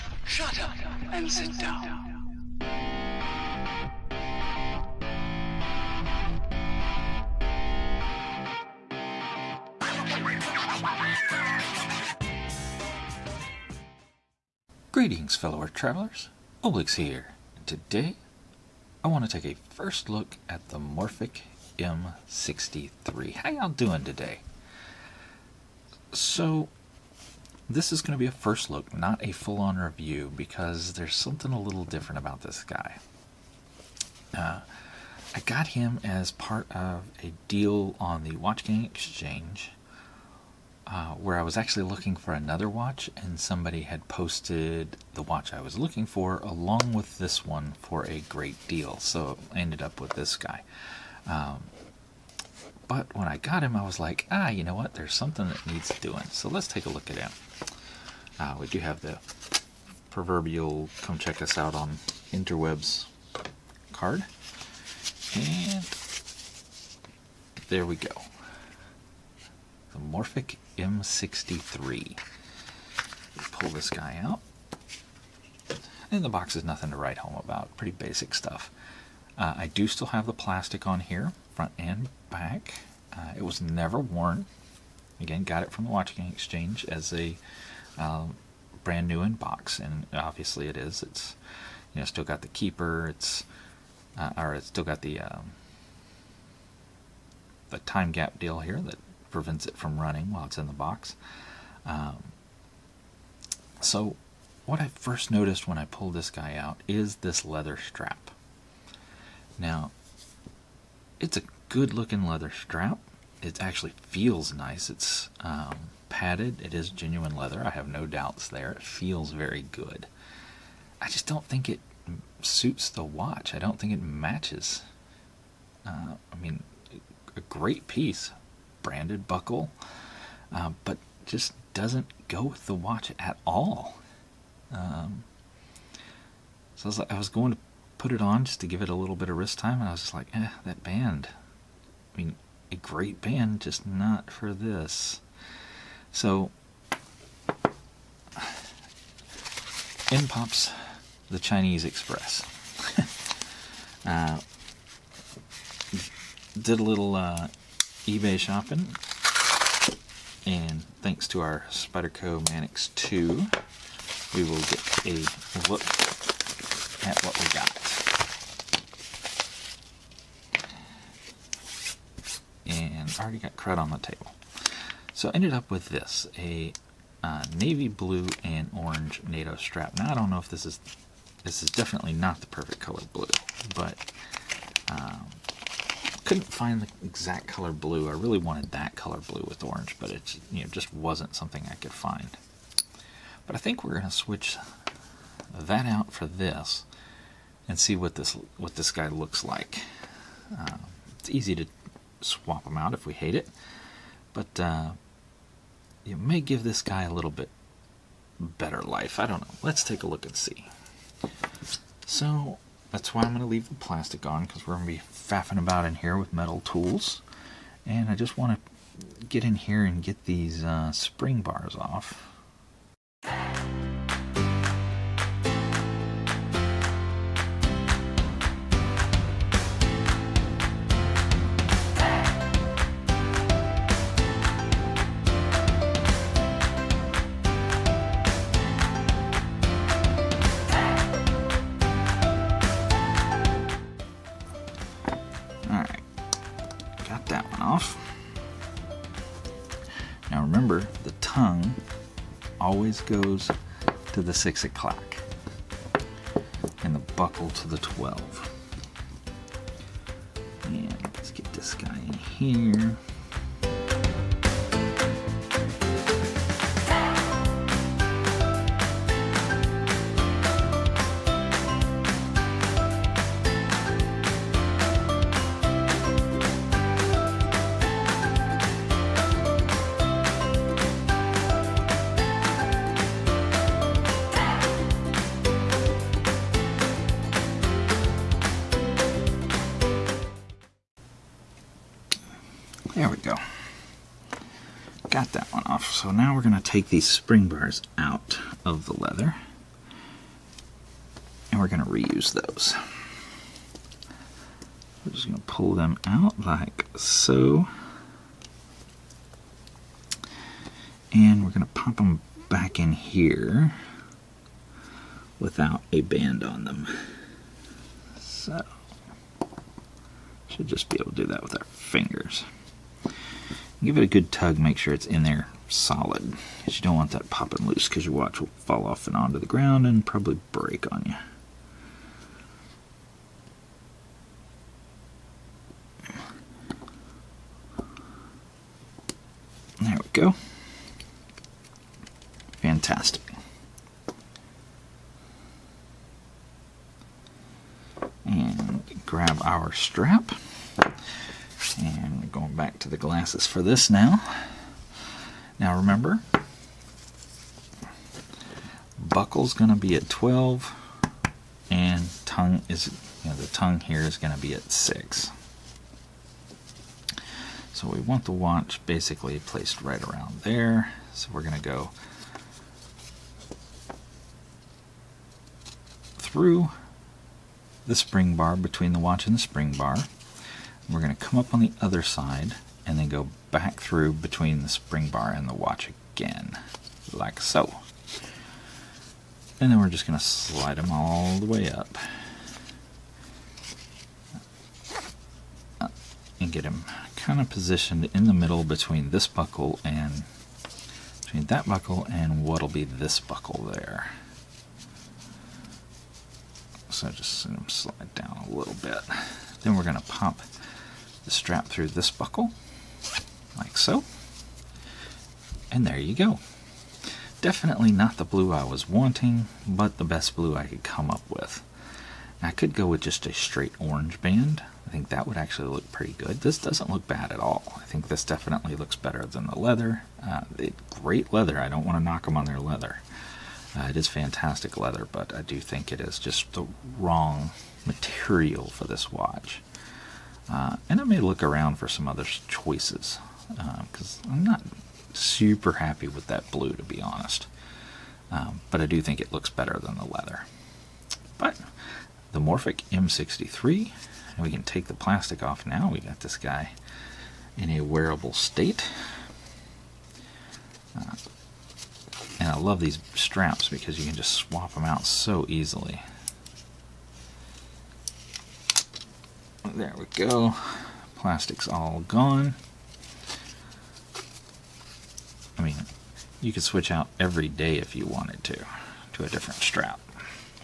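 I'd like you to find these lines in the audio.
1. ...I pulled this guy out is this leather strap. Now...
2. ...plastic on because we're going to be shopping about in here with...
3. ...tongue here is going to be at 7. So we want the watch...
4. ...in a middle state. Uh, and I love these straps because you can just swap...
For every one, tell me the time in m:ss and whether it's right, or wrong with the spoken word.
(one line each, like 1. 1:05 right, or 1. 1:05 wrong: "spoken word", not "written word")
1. 1:45 right
2. 3:33 wrong: "faffing", not "shopping"
3. 6:03 wrong: "6", not "7"
4. 7:37 wrong: "wearable", not "middle".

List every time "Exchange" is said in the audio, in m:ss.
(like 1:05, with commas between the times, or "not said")
0:38, 1:26.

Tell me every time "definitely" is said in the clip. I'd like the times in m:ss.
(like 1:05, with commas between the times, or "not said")
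3:01, 6:57, 7:08.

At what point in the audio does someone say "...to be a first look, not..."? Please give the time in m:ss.
0:28.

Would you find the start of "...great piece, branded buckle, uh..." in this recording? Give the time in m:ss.
2:07.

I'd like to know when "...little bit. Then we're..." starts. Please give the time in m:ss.
6:48.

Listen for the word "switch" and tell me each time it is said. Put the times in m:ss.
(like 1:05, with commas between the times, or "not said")
3:14, 7:56.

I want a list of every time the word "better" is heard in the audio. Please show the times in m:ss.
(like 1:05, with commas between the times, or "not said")
3:28, 7:08, 7:29.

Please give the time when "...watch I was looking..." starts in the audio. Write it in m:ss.
0:45.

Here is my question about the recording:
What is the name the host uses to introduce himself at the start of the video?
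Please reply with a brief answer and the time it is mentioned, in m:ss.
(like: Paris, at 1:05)
Oblix, at 0:16.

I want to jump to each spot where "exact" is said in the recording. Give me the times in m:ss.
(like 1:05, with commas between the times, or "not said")
3:07.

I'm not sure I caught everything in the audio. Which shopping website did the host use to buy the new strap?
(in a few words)
eBay.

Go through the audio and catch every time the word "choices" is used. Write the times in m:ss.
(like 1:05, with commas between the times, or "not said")
7:22.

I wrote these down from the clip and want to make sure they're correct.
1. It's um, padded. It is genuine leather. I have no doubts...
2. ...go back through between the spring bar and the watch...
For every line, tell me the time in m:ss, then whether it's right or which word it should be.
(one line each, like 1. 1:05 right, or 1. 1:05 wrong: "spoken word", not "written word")
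1. 1:54 right
2. 6:23 right.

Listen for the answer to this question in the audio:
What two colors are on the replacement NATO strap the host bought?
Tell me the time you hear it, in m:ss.
2:57.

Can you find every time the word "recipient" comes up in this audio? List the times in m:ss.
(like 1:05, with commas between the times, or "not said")
not said.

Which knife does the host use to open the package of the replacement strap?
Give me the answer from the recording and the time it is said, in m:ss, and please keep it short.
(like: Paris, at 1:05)
Spyderco Manix 2, at 2:41.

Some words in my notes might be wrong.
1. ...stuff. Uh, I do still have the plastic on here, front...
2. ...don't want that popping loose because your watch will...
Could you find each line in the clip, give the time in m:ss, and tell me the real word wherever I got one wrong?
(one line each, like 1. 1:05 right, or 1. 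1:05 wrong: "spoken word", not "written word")
1. 1:18 right
2. 5:26 right.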